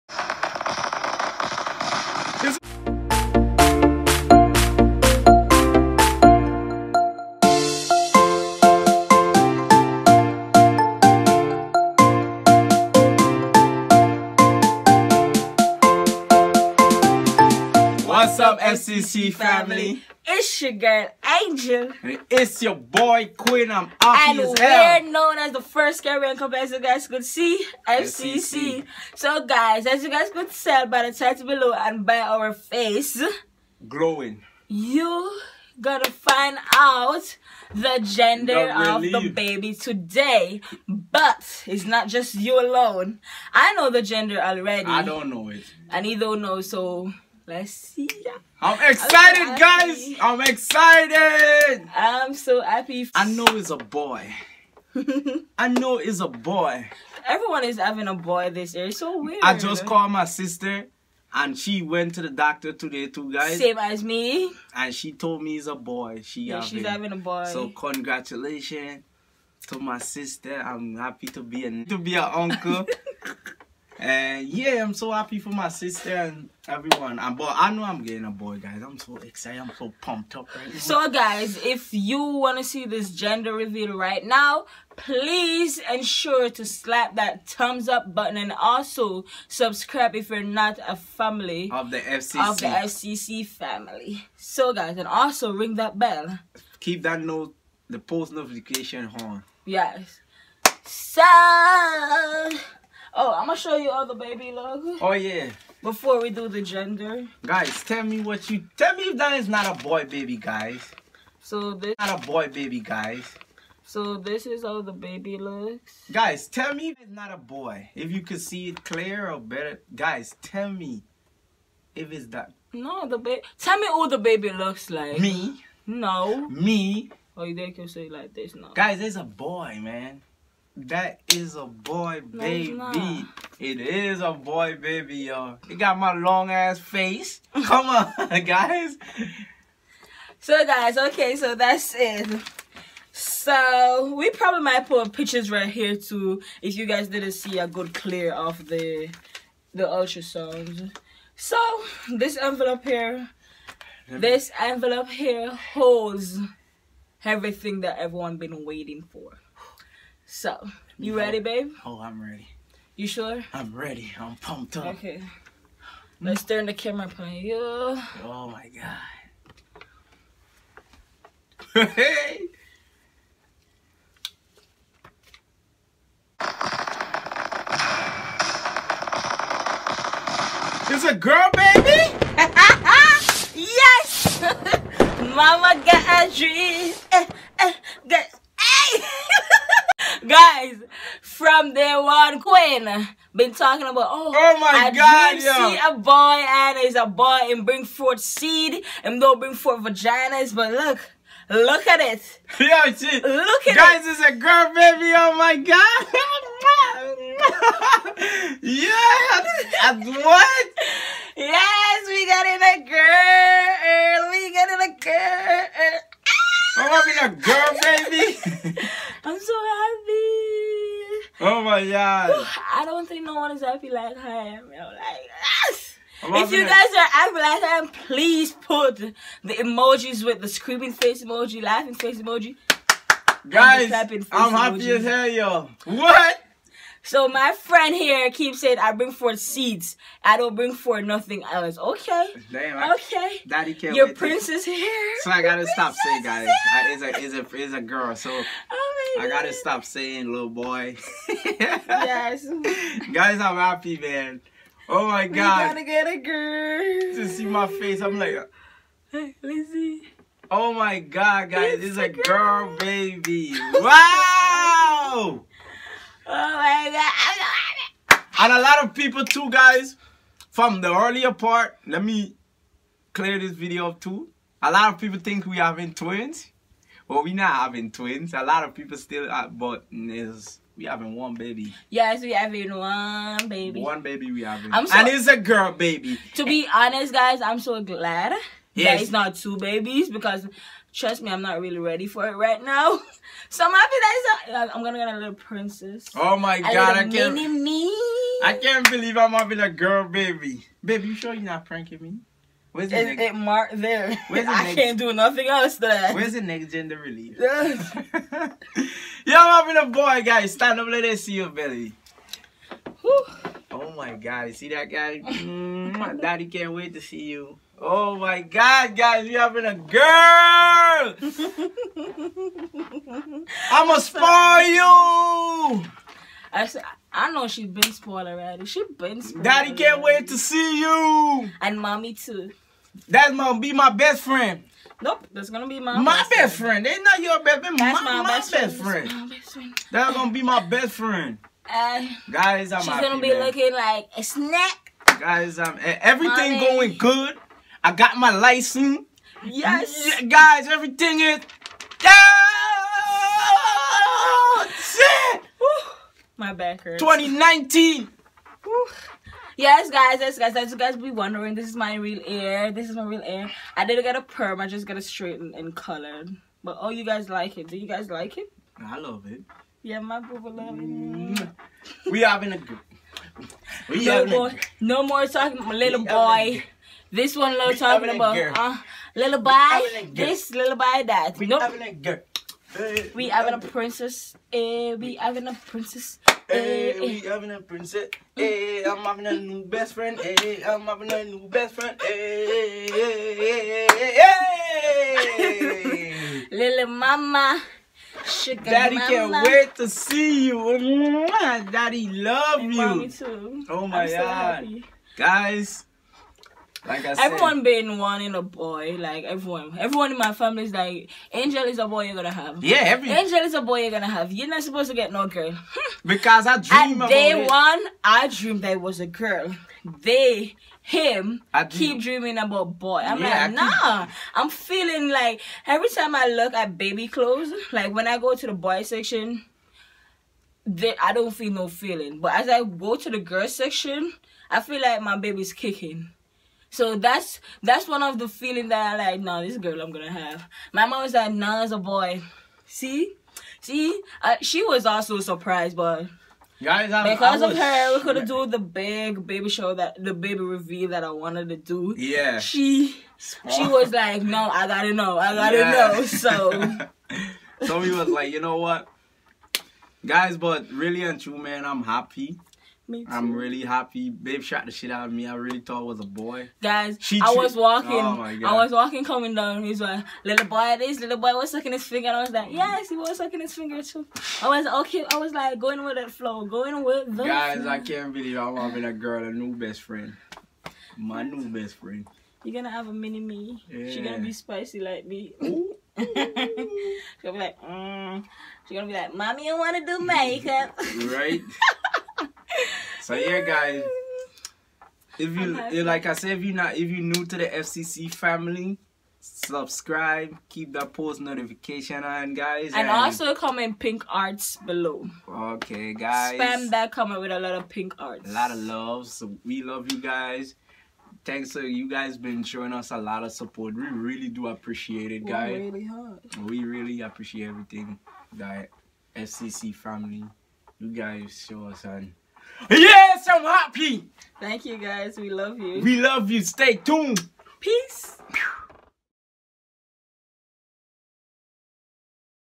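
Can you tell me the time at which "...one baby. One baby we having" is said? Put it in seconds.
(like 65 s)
282 s.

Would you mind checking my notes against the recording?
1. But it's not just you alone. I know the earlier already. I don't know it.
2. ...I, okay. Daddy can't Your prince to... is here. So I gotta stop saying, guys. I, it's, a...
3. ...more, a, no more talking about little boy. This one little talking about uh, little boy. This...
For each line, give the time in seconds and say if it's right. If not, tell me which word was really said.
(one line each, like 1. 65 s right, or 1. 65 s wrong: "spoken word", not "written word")
1. 40 s wrong: "gender", not "earlier"
2. 242 s right
3. 374 s right.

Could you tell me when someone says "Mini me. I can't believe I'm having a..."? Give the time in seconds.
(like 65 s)
297 s.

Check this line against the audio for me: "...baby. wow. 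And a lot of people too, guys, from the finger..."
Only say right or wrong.
wrong.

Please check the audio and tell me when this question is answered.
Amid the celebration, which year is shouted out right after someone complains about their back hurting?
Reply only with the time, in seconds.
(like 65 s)
357 s.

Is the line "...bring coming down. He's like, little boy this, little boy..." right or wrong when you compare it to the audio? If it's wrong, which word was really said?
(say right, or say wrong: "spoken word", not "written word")
wrong: "walking", not "bring".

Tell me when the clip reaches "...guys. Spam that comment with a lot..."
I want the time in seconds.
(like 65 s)
505 s.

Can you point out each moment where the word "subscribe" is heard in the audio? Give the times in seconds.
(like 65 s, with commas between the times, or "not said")
89 s, 499 s.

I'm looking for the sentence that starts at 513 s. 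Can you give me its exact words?
We really do appreciate it, guys.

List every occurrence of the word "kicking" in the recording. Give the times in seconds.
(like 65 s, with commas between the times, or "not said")
435 s.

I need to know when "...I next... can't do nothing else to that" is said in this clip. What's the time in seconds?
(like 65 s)
304 s.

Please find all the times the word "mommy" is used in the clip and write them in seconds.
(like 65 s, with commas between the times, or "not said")
331 s, 402 s, 489 s.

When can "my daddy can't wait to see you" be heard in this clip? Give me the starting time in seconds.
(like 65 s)
315 s.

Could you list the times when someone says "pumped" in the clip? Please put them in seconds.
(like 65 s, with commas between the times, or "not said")
80 s, 164 s.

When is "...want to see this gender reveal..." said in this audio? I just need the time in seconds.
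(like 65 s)
82 s.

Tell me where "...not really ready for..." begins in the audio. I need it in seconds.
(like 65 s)
291 s.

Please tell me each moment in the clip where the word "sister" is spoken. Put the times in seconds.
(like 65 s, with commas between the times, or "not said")
60 s, 69 s, 75 s.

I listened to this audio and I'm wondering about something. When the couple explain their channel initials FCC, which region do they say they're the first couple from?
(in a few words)
Caribbean.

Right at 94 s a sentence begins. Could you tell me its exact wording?
So guys, and also ring that bell.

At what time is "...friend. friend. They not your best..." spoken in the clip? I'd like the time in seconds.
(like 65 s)
336 s.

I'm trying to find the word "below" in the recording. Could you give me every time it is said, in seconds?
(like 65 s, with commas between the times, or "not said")
31 s, 504 s.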